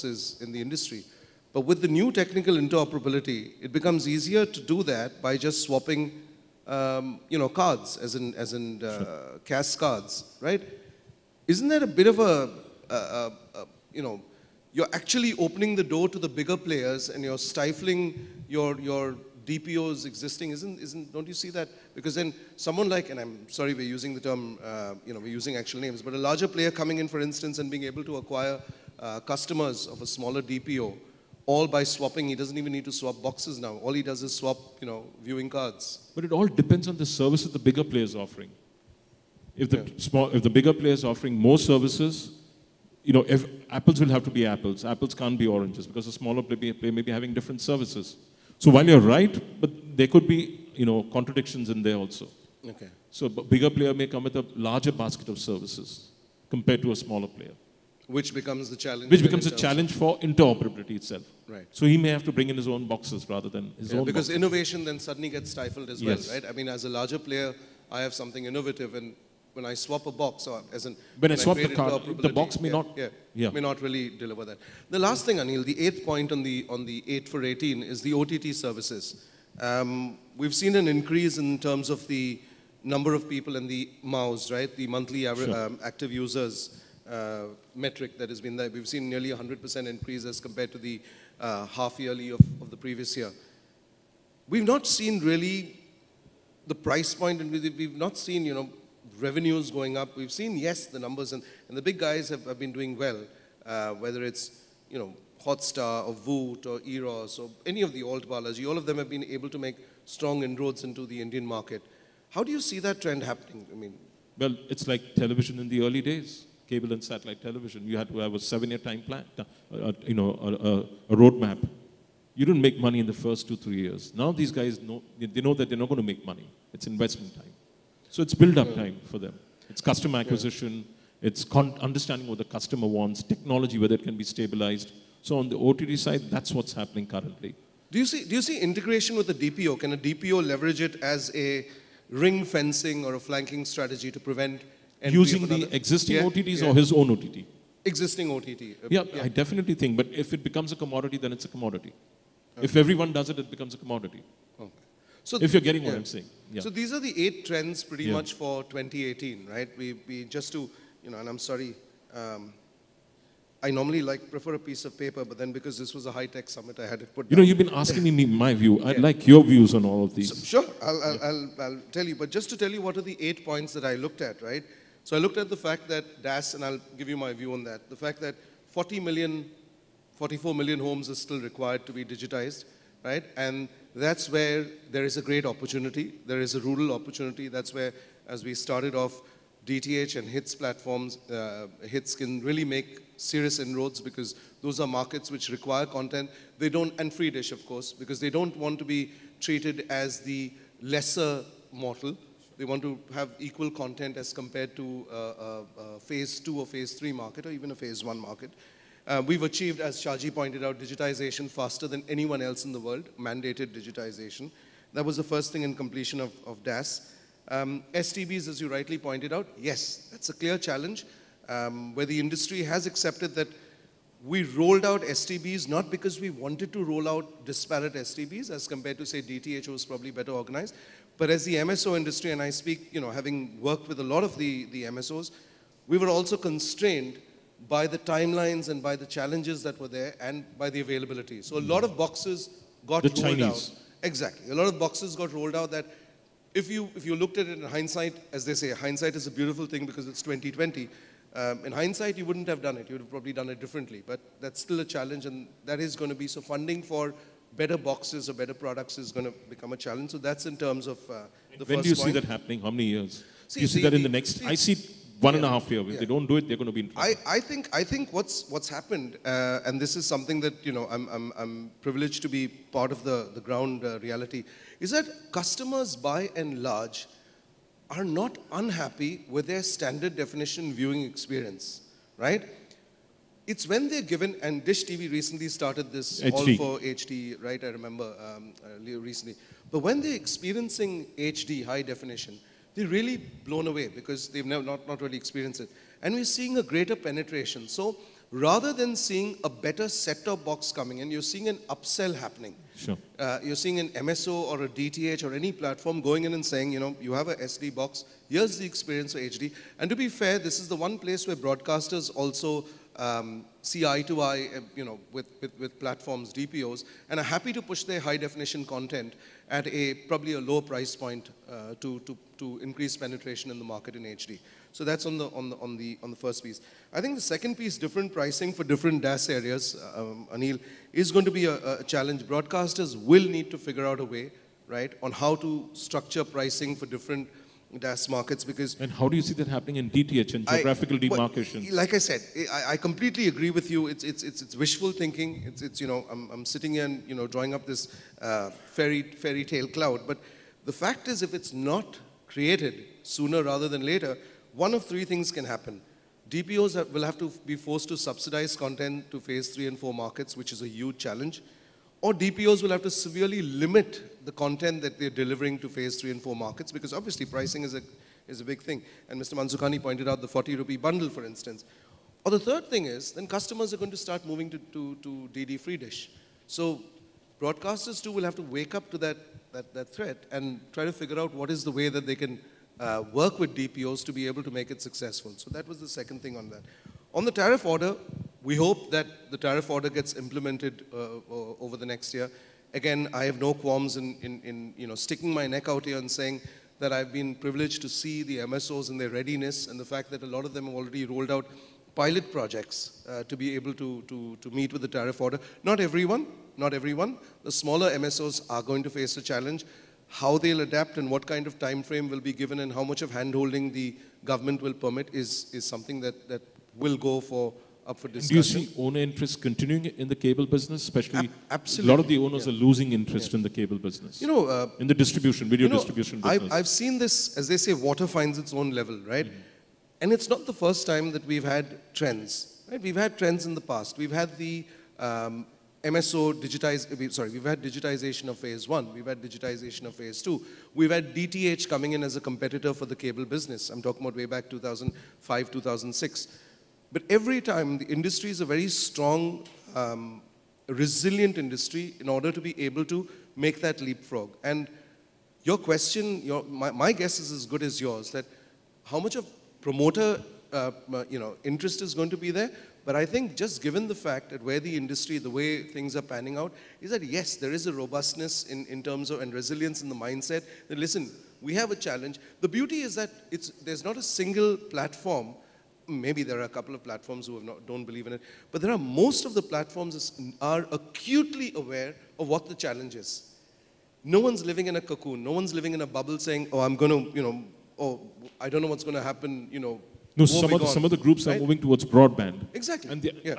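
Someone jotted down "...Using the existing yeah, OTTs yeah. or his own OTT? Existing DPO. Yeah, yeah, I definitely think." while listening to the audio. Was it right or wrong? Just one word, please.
wrong.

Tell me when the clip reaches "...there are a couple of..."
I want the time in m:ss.
7:56.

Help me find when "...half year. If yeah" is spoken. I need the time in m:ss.
4:25.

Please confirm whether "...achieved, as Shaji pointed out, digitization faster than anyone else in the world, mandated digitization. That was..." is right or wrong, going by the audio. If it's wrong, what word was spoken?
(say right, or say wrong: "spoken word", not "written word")
right.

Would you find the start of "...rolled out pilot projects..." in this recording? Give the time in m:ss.
6:41.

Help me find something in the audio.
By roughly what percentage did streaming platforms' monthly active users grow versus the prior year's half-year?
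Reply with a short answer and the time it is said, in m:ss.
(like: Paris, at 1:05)
100%, at 1:29.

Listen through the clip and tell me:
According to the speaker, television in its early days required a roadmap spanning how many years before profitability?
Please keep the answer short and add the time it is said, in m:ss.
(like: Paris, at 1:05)
7 years, at 1:58.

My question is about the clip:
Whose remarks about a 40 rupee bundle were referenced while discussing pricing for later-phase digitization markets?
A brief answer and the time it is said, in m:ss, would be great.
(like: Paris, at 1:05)
Mr. Mansukhani, at 6:09.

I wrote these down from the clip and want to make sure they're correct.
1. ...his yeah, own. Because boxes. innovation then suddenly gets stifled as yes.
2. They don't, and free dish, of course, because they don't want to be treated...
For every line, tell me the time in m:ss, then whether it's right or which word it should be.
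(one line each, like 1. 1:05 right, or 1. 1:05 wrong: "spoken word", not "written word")
1. 1:03 right
2. 3:16 right.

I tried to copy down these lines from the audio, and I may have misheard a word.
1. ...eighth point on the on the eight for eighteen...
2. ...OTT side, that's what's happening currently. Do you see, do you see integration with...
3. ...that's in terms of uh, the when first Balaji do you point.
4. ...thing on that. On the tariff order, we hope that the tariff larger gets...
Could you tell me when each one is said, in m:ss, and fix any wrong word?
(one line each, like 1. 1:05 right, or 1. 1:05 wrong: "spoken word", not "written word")
1. 1:15 right
2. 2:15 right
3. 4:20 wrong: "When", not "Balaji"
4. 6:26 wrong: "order", not "larger".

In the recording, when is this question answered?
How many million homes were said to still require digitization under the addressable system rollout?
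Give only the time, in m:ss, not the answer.
3:00.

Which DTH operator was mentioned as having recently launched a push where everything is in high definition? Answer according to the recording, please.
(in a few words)
Dish TV.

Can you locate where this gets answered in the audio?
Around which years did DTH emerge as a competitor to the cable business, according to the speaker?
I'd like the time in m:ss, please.
7:24.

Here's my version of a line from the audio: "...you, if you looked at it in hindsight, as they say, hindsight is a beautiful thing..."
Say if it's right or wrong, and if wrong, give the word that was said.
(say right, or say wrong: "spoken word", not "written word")
right.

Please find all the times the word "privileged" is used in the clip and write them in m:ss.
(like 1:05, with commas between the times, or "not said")
4:31, 6:37.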